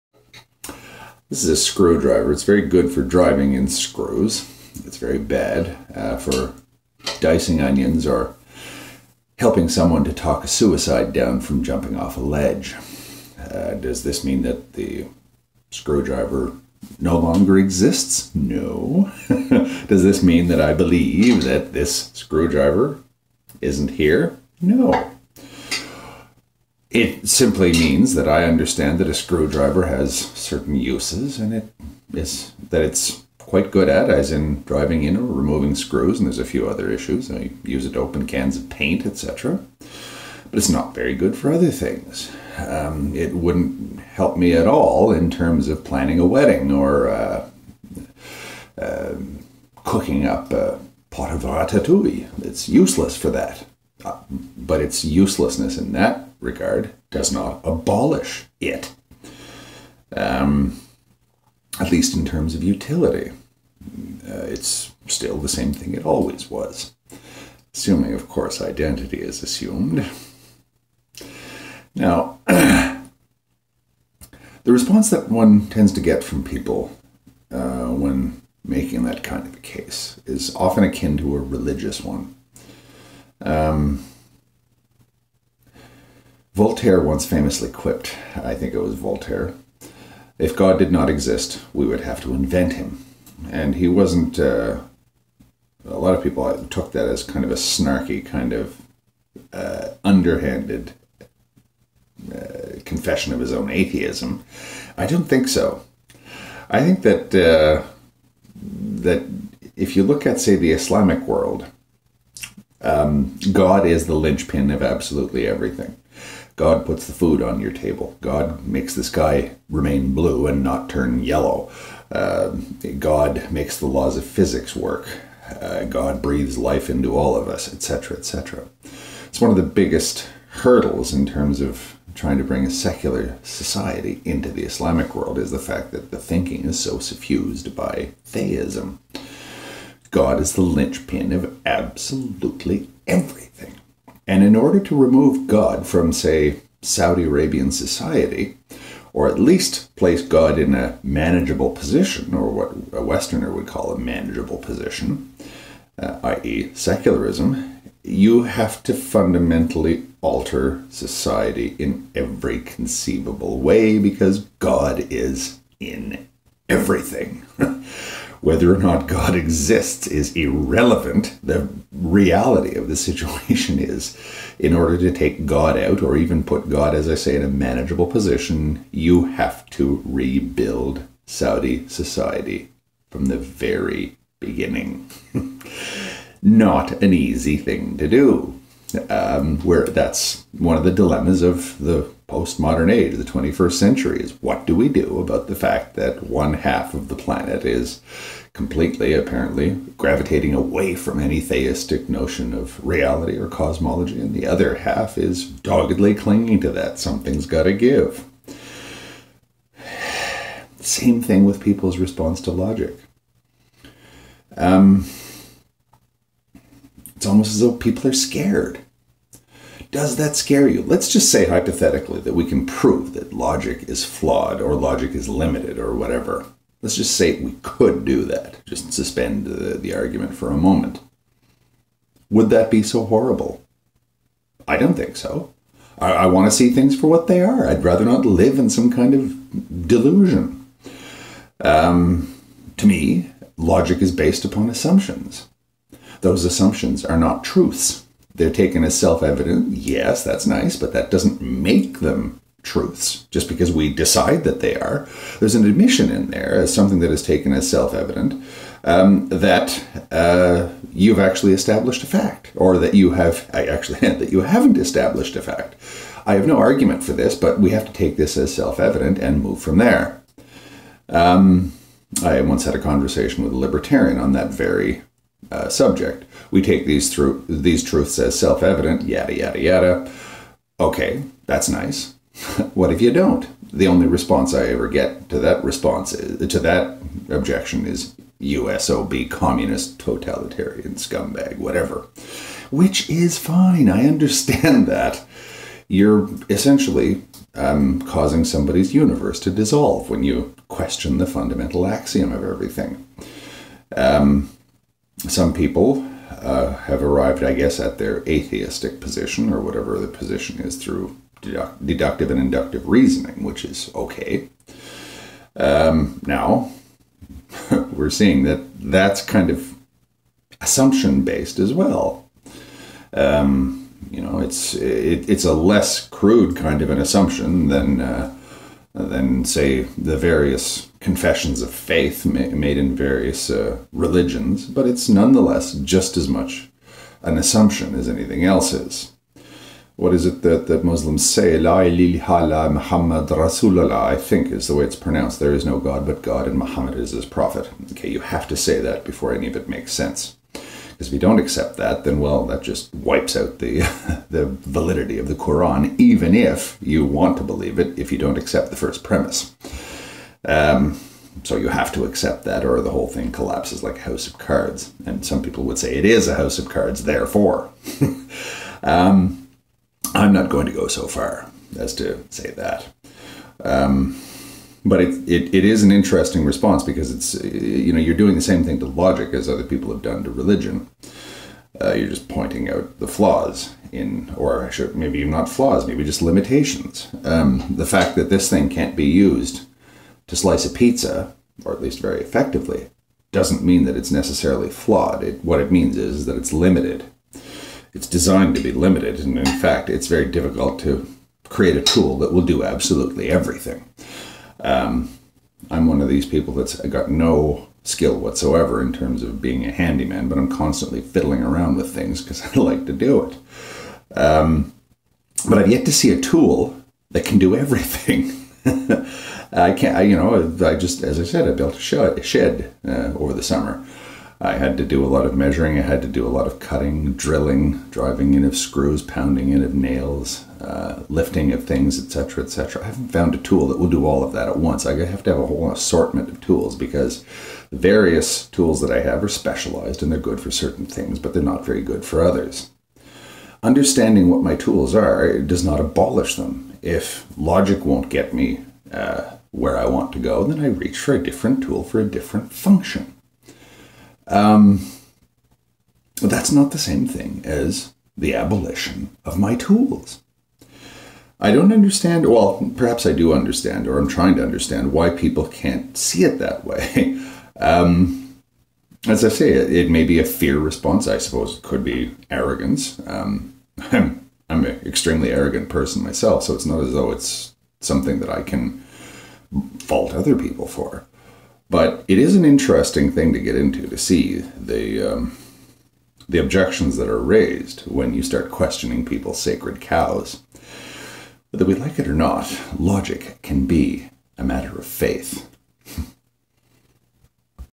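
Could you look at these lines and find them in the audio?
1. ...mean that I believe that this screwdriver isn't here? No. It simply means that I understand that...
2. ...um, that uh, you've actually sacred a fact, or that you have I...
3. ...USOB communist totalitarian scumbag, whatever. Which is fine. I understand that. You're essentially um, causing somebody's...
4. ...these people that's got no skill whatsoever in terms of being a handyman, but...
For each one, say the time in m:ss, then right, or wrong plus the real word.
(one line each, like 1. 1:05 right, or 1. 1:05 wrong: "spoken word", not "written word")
1. 0:20 right
2. 4:18 wrong: "established", not "sacred"
3. 4:48 right
4. 6:46 right.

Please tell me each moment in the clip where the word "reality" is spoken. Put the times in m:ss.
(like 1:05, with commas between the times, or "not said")
2:51, 3:22.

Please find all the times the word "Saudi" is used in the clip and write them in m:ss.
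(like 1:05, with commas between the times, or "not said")
2:26, 3:01.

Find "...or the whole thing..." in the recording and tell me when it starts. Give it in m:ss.
6:02.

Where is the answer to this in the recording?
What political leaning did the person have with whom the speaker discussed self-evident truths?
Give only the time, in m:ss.
4:33.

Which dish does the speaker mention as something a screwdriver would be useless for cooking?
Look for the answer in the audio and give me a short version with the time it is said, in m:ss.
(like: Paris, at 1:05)
ratatouille, at 0:51.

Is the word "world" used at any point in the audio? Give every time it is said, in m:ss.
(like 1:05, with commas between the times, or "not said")
1:51, 2:15.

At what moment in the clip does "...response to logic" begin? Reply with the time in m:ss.
3:31.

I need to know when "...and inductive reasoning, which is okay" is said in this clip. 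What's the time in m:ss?
5:12.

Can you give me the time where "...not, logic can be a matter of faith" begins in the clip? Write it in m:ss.
8:12.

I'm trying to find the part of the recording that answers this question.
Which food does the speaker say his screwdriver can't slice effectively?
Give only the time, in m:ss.
6:30.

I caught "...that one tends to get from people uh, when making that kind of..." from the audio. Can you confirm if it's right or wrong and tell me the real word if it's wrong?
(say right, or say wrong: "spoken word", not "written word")
right.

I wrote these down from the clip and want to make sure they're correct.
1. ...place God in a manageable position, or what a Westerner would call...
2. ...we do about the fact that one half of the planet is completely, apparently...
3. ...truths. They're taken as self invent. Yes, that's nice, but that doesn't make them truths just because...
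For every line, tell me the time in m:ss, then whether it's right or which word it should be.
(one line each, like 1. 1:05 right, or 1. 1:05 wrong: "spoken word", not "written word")
1. 2:29 right
2. 3:14 right
3. 4:07 wrong: "evident", not "invent".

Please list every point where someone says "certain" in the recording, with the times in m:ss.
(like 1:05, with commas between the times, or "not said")
0:30, 7:20.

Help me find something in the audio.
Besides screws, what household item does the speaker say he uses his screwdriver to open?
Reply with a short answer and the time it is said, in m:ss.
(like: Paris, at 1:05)
cans of paint, at 0:38.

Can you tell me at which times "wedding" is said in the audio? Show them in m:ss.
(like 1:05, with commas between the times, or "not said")
0:46.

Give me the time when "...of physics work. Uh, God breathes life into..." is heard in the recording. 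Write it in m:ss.
2:04.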